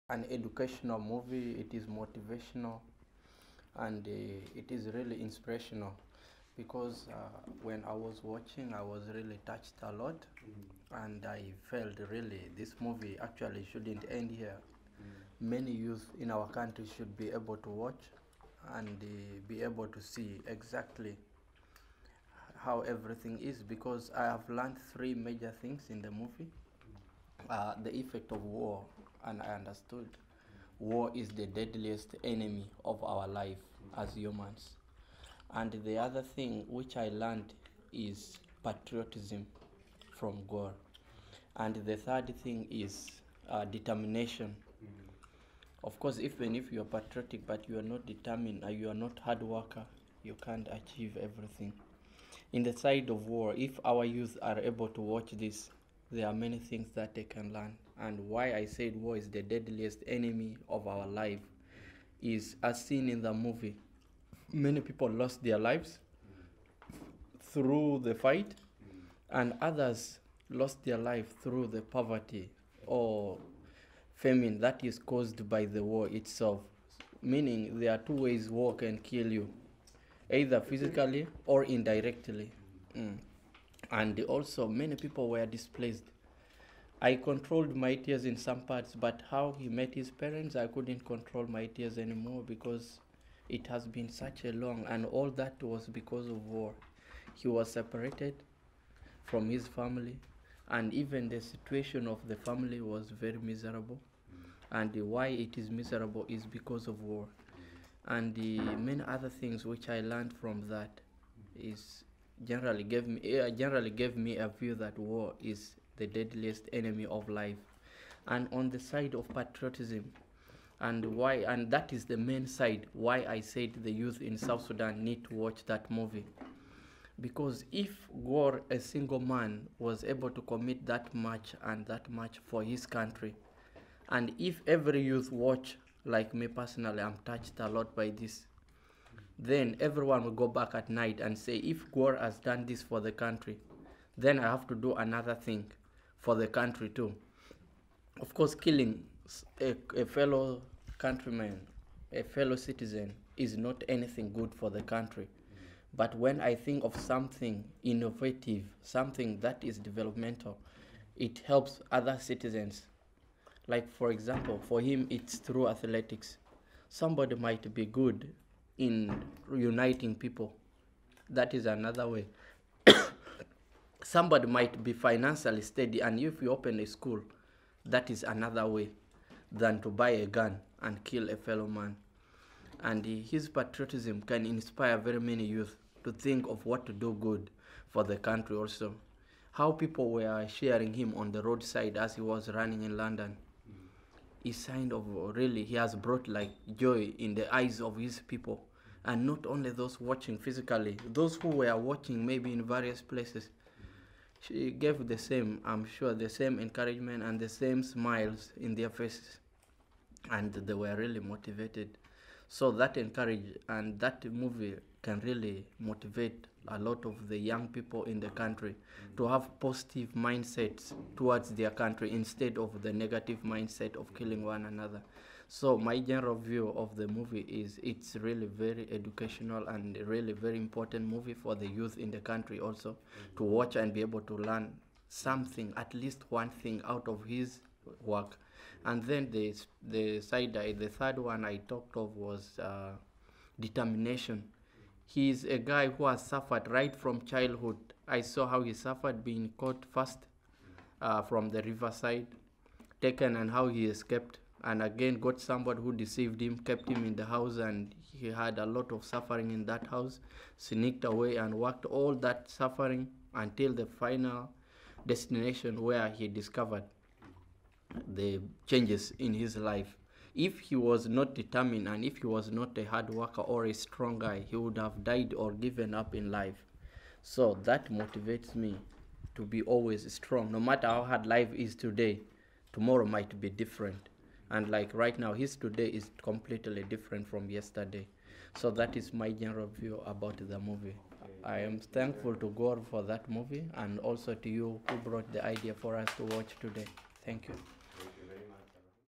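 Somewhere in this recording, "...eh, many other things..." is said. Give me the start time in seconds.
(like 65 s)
108 s.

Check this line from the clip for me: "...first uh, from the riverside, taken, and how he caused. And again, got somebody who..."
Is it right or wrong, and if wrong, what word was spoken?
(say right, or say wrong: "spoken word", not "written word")
wrong: "escaped", not "caused".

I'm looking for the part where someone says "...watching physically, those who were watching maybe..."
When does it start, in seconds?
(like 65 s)
199 s.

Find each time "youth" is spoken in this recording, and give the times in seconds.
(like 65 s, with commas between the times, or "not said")
15 s, 54 s, 123 s, 135 s, 185 s, 231 s.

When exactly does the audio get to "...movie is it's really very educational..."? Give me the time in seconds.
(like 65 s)
227 s.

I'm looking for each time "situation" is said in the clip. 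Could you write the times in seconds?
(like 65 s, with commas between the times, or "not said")
101 s.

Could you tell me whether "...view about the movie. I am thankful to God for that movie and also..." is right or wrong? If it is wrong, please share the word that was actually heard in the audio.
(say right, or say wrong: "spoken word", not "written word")
right.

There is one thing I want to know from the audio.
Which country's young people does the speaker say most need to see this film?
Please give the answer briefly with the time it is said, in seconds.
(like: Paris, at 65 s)
South Sudan, at 124 s.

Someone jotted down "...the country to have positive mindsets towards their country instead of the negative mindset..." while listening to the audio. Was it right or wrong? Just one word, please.
right.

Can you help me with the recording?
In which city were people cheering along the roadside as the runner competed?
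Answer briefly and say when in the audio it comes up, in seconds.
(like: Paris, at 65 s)
London, at 192 s.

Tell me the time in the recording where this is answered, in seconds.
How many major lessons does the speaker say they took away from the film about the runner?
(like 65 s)
24 s.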